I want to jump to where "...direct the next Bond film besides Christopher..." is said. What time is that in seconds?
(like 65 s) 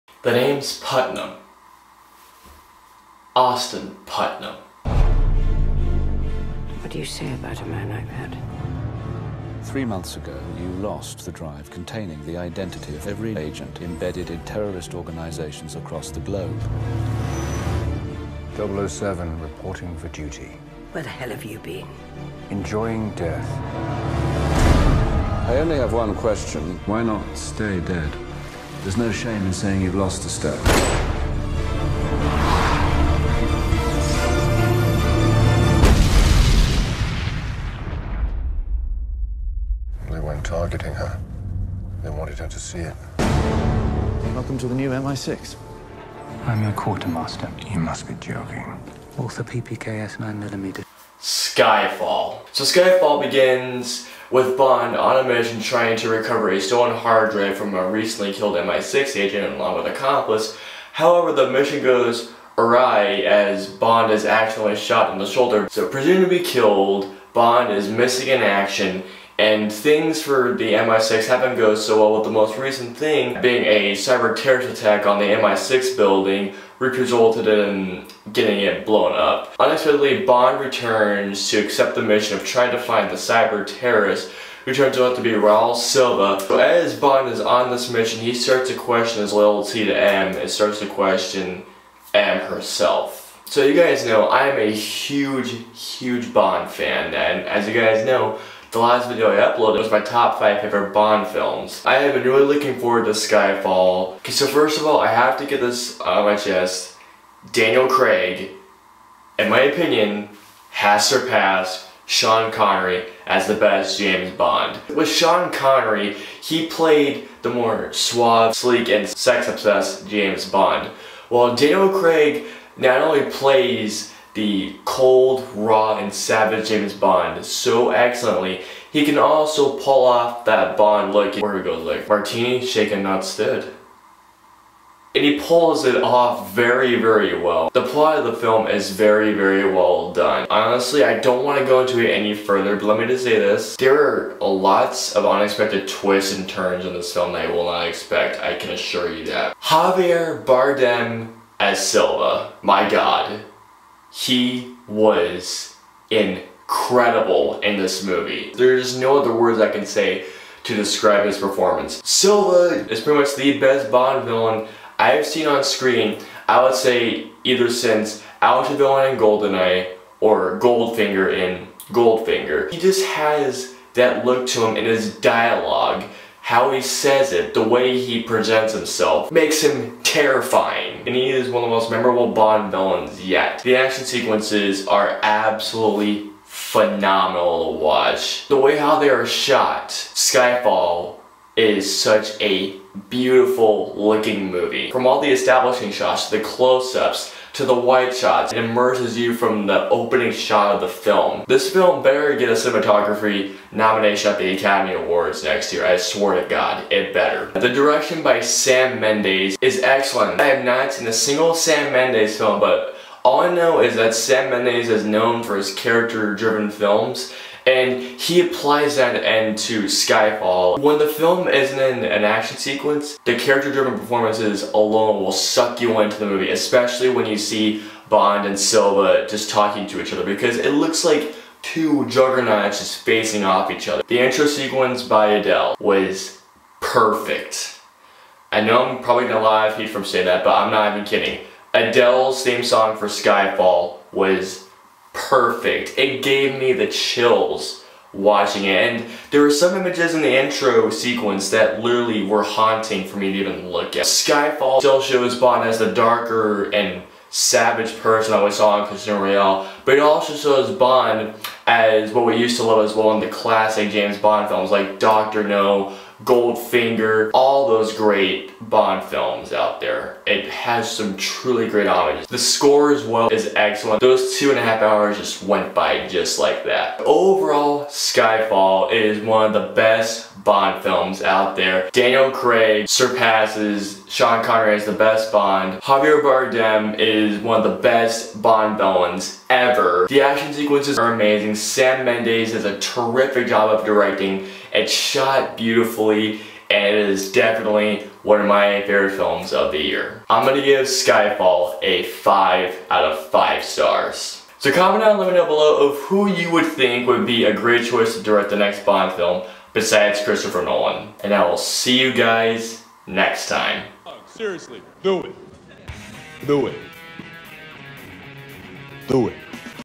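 308 s.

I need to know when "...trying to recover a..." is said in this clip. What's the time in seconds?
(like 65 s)
55 s.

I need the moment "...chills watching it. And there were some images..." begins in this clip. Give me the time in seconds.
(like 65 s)
246 s.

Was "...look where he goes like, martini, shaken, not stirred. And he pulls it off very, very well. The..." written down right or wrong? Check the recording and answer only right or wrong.
right.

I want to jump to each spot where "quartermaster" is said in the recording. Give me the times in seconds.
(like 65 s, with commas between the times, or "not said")
46 s.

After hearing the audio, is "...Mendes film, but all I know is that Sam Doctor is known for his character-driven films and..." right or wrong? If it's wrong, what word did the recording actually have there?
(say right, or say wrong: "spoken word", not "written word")
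wrong: "Mendes", not "Doctor".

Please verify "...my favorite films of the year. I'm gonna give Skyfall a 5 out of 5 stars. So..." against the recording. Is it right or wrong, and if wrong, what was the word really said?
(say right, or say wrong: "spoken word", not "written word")
right.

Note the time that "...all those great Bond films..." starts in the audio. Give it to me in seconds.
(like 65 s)
267 s.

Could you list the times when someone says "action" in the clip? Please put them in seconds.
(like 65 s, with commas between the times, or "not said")
68 s, 183 s, 222 s, 290 s.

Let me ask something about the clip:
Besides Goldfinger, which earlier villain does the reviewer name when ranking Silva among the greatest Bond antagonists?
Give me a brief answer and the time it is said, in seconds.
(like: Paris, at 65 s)
Alec Trevelyan, at 168 s.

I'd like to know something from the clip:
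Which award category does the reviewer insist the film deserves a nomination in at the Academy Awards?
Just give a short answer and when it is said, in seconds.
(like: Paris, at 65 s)
Cinematography, at 202 s.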